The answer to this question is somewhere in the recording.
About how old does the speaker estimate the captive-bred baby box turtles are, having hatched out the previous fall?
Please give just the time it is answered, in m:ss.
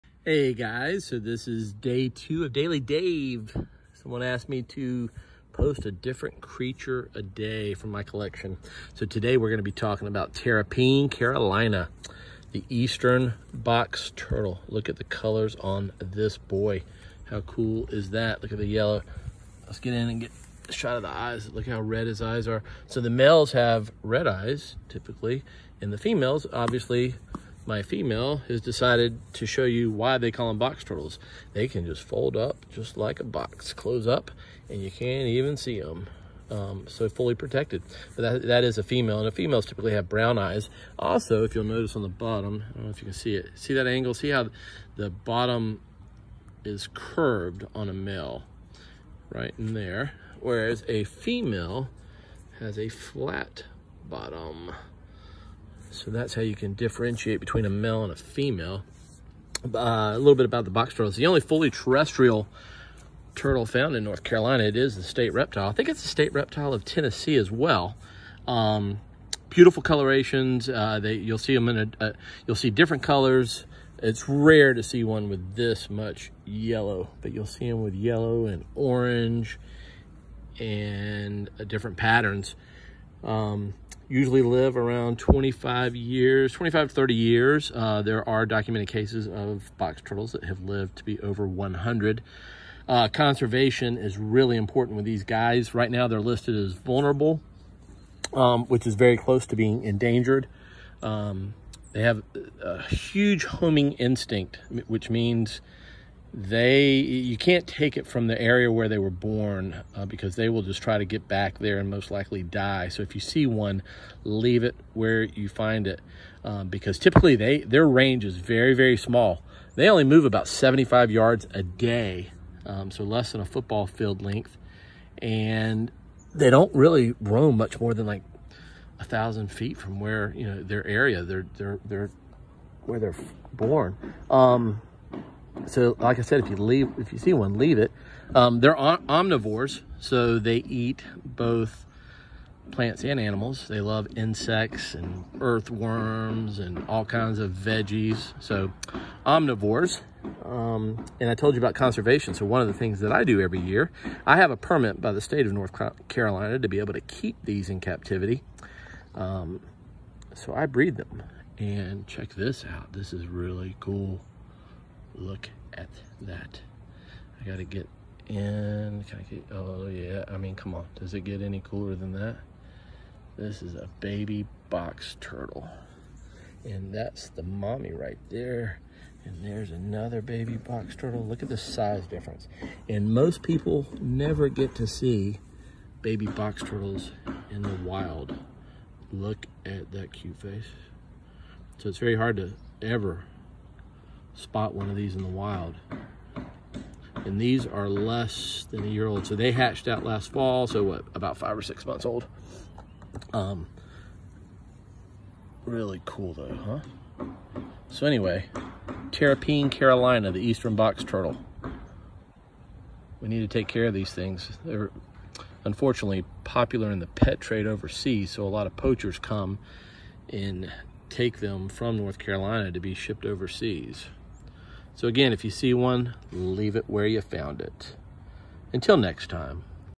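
3:21.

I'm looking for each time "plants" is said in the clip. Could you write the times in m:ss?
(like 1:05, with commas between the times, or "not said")
2:22.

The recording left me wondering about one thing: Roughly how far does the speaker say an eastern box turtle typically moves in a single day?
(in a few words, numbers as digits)
75 yards.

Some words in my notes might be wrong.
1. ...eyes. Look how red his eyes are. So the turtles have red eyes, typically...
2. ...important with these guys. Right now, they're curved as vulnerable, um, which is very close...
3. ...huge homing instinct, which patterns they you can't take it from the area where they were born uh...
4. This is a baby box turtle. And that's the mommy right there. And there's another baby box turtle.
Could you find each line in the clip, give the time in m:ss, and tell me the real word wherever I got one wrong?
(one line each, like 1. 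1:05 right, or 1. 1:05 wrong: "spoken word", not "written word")
1. 0:21 wrong: "males", not "turtles"
2. 1:34 wrong: "listed", not "curved"
3. 1:42 wrong: "means", not "patterns"
4. 2:53 right.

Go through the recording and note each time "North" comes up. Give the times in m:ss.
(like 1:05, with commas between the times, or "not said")
1:04, 2:35, 3:41.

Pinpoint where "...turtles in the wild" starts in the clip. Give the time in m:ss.
3:06.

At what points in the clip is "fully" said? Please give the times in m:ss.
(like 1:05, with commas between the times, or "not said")
0:37, 1:01.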